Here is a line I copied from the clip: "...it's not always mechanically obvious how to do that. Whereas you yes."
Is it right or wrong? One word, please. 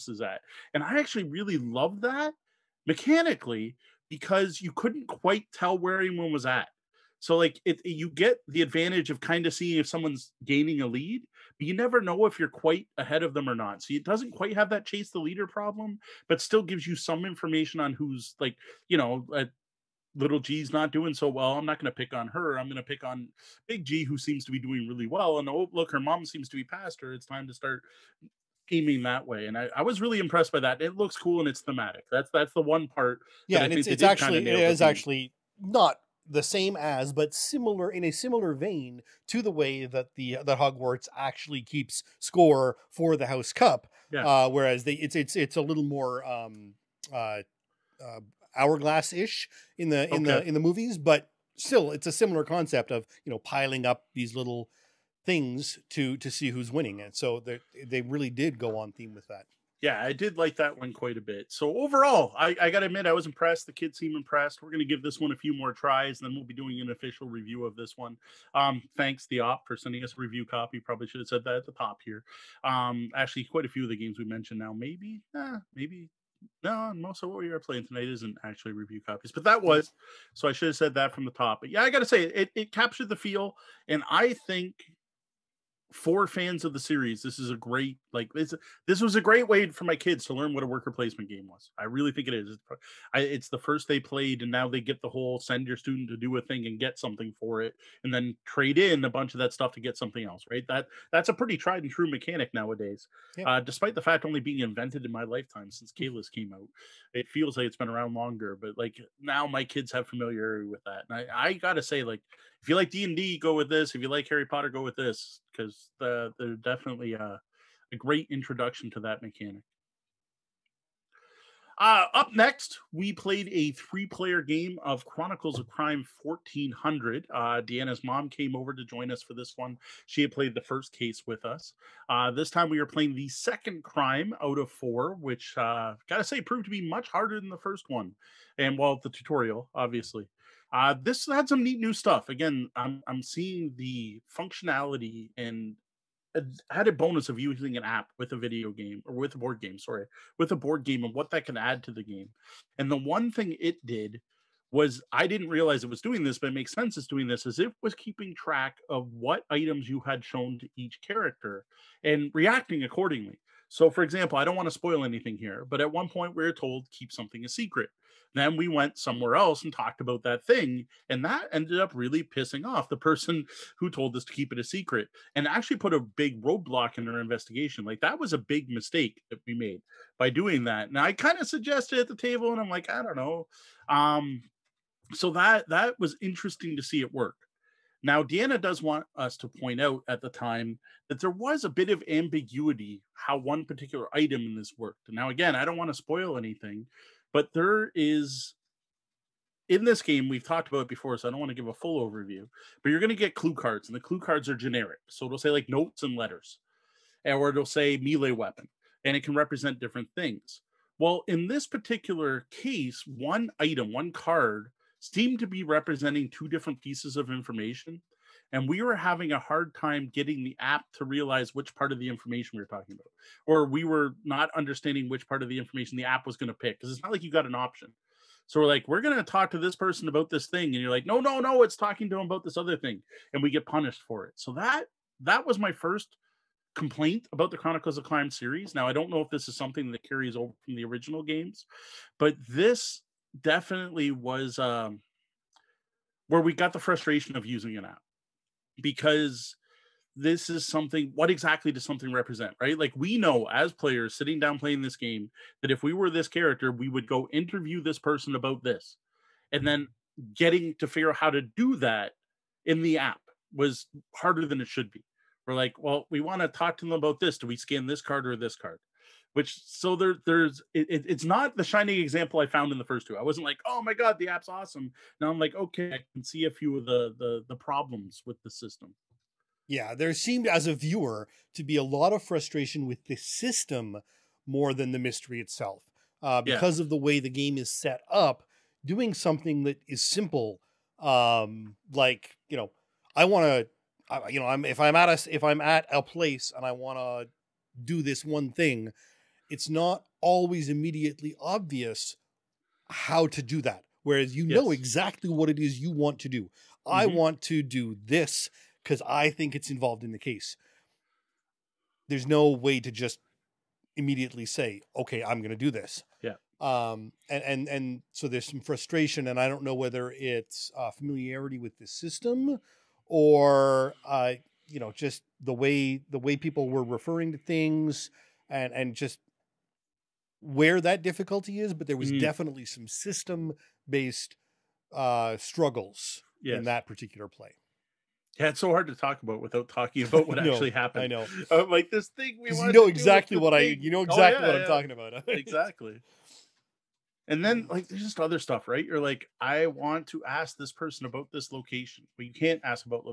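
wrong.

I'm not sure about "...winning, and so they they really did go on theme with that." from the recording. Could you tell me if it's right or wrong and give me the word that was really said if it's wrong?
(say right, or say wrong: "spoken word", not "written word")
right.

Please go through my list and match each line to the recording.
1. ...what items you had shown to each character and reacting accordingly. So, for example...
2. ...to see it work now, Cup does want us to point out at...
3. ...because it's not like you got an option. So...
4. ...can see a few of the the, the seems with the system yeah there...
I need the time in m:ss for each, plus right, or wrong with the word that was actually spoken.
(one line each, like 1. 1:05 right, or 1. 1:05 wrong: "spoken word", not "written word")
1. 2:39 right
2. 3:06 wrong: "Deanna", not "Cup"
3. 3:46 right
4. 4:36 wrong: "problems", not "seems".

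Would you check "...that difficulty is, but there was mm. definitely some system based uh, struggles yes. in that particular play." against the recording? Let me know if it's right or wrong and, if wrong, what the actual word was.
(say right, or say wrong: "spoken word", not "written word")
right.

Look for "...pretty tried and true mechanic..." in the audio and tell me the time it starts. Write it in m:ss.
1:41.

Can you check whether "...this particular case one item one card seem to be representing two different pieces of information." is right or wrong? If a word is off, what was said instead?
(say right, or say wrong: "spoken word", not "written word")
right.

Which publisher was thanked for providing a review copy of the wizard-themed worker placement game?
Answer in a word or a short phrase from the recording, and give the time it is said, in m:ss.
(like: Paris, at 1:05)
The Op, at 1:09.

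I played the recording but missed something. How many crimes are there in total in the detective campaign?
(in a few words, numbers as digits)
4.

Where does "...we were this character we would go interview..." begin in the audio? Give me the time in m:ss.
4:15.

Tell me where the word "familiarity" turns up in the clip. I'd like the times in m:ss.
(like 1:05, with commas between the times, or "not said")
1:50, 5:20.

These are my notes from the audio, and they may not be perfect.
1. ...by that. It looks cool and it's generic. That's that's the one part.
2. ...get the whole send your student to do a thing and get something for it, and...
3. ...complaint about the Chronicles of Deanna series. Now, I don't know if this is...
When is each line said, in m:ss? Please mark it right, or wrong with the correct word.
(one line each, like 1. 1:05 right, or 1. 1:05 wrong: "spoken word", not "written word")
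1. 0:30 wrong: "thematic", not "generic"
2. 1:34 right
3. 3:56 wrong: "Crime", not "Deanna".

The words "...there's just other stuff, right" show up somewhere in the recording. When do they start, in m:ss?
5:47.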